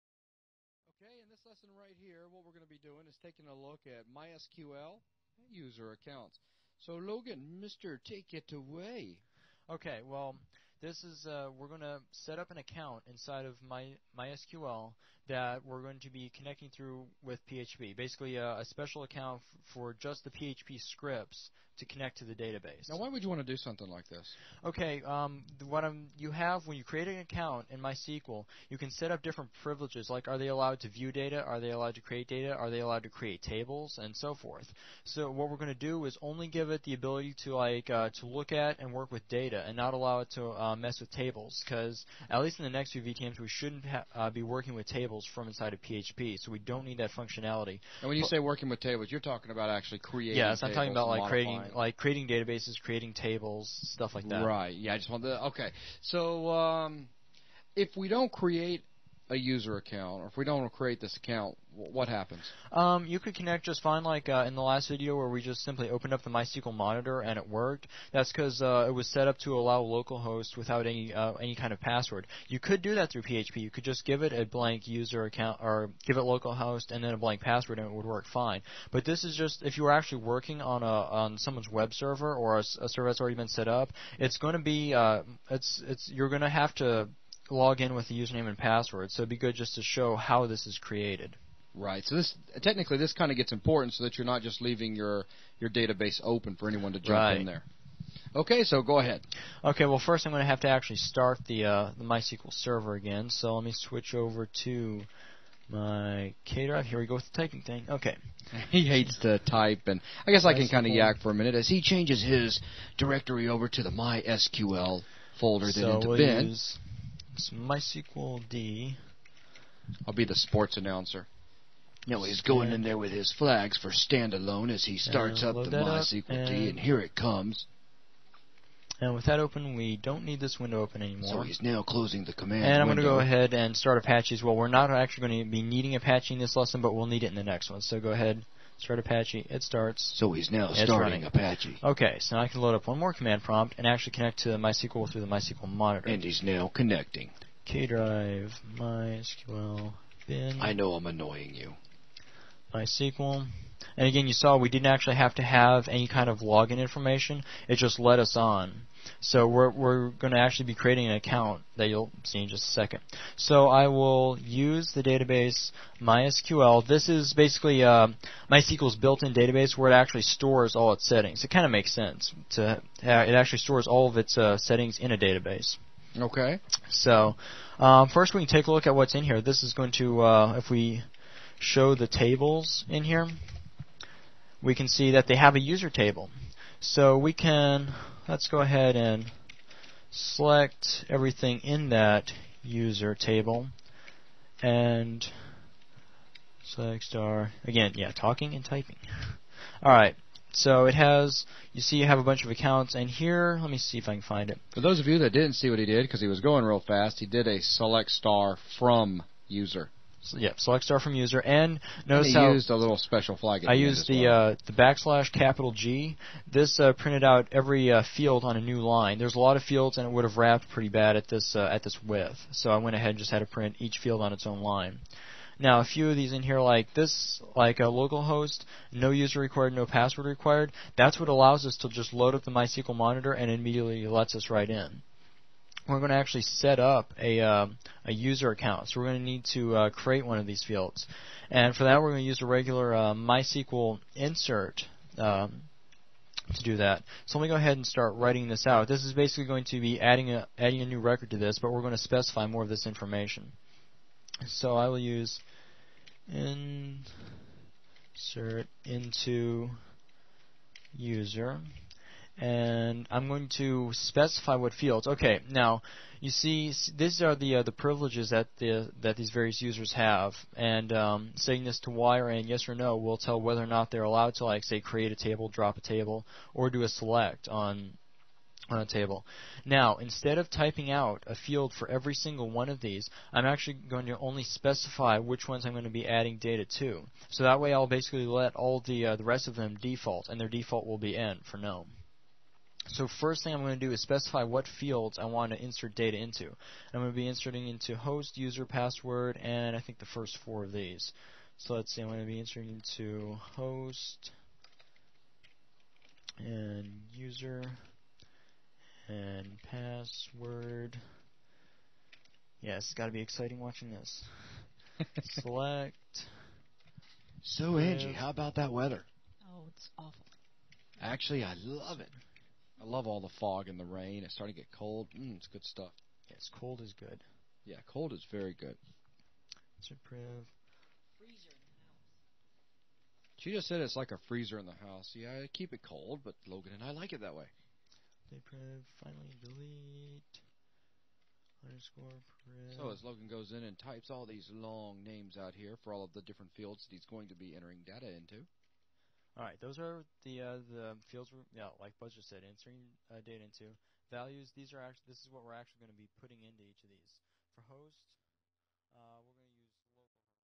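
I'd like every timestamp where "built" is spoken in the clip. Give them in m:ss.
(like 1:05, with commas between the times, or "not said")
2:48.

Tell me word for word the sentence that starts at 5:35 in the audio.
Yeah, I keep it cold, but Logan and I like it that way.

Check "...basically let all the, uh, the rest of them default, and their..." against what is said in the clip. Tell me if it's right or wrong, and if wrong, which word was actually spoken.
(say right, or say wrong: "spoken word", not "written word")
right.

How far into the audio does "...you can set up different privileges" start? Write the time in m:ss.
0:28.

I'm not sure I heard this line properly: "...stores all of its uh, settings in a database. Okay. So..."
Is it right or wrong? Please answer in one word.
right.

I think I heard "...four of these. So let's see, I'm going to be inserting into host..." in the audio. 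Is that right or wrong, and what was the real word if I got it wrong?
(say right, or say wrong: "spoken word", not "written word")
right.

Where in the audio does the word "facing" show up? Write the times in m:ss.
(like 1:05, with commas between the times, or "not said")
not said.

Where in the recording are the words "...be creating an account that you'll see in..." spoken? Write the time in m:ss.
2:40.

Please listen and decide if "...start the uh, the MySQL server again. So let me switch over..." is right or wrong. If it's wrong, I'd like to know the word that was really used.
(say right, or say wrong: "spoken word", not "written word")
right.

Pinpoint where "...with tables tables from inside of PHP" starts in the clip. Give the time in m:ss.
0:44.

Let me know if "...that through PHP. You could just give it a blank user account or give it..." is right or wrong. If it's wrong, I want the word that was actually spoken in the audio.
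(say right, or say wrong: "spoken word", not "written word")
right.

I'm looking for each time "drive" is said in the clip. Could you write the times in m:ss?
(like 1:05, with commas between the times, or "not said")
1:46, 2:27.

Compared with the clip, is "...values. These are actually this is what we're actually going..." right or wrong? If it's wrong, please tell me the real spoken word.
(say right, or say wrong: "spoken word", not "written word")
right.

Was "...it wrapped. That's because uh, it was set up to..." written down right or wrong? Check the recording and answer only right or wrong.
wrong.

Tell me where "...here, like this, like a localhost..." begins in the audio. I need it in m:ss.
3:46.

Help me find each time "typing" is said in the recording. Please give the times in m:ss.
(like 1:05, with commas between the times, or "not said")
1:47, 3:18, 4:40.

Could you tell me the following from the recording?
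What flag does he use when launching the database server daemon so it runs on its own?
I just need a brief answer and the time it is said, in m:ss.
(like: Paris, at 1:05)
standalone, at 2:03.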